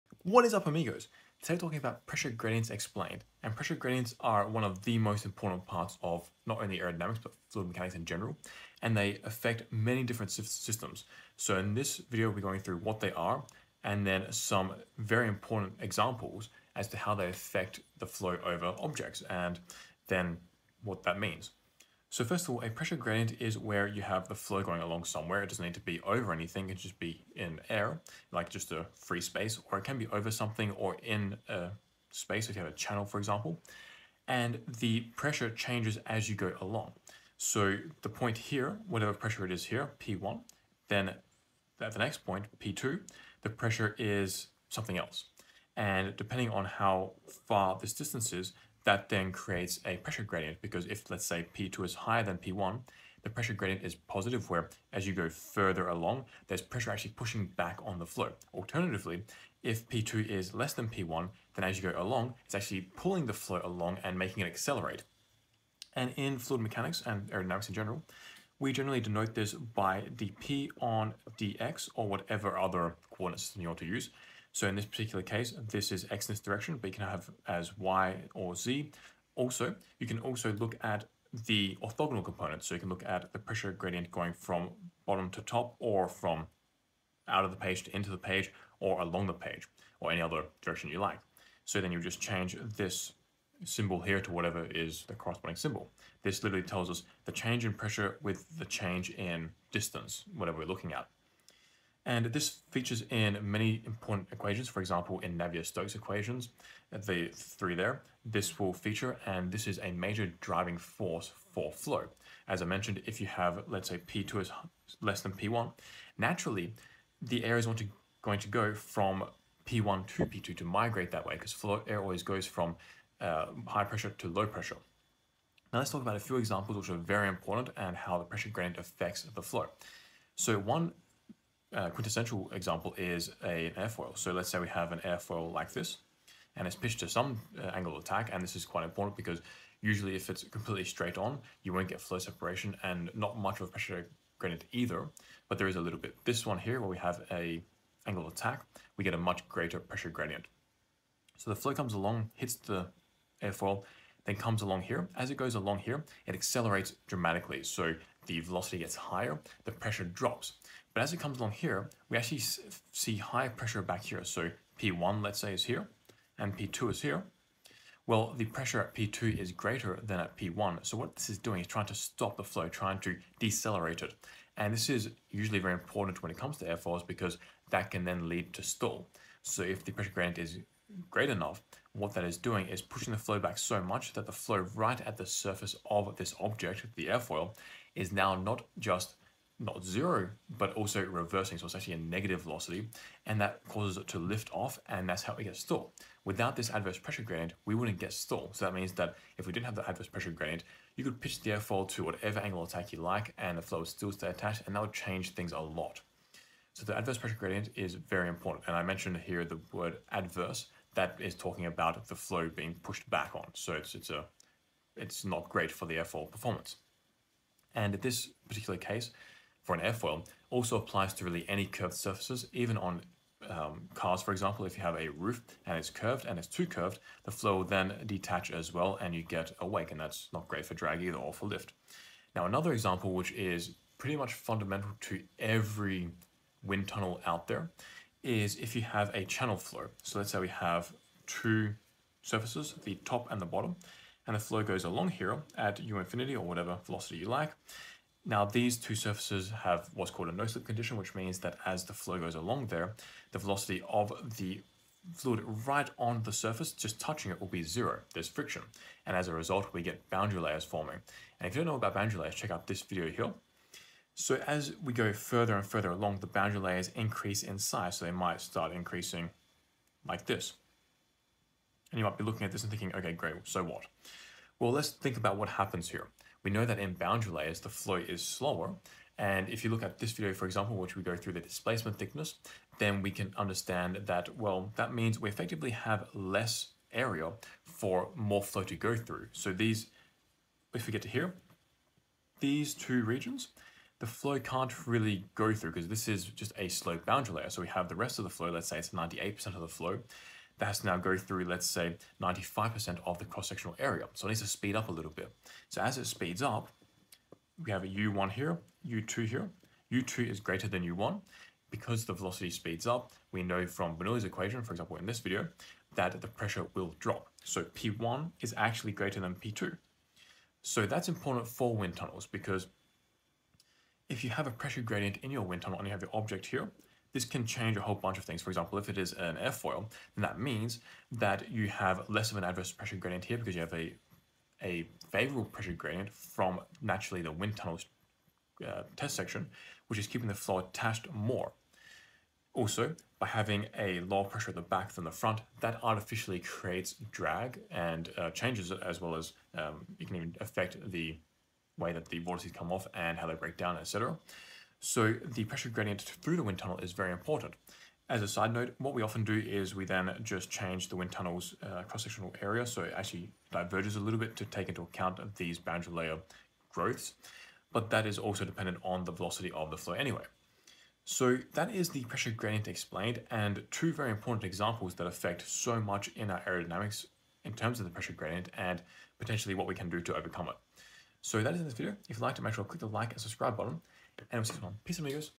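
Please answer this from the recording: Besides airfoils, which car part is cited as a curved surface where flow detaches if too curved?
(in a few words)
roof.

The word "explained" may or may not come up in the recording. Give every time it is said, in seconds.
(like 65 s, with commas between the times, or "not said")
2 s, 372 s.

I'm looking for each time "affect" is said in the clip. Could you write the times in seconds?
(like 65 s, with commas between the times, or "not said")
9 s, 17 s, 128 s, 350 s, 375 s.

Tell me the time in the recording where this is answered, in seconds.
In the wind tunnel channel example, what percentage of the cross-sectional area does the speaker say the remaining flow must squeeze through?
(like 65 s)
302 s.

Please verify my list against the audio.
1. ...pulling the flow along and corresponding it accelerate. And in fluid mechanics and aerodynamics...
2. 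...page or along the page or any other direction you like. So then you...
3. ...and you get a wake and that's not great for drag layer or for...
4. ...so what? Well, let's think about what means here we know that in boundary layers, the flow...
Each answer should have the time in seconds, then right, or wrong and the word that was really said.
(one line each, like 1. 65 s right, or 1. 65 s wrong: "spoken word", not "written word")
1. 62 s wrong: "making", not "corresponding"
2. 88 s right
3. 229 s wrong: "either", not "layer"
4. 273 s wrong: "happens", not "means".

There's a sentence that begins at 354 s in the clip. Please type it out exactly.
So the pressure gradient through the wind tunnel is very important.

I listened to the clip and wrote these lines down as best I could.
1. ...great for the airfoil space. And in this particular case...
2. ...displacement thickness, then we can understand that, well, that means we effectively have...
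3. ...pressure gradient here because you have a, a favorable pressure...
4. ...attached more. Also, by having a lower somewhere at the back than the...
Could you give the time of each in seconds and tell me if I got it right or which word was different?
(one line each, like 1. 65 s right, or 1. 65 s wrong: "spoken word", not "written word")
1. 215 s wrong: "performance", not "space"
2. 281 s right
3. 332 s right
4. 340 s wrong: "pressure", not "somewhere".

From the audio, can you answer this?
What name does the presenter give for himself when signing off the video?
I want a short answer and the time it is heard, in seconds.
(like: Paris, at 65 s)
Six One, at 384 s.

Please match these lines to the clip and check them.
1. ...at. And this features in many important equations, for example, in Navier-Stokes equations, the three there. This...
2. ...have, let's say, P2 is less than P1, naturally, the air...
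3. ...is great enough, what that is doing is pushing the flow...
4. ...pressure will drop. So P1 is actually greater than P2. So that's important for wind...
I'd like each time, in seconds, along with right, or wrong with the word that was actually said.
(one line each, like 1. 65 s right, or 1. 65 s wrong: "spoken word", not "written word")
1. 100 s right
2. 113 s right
3. 180 s right
4. 316 s right.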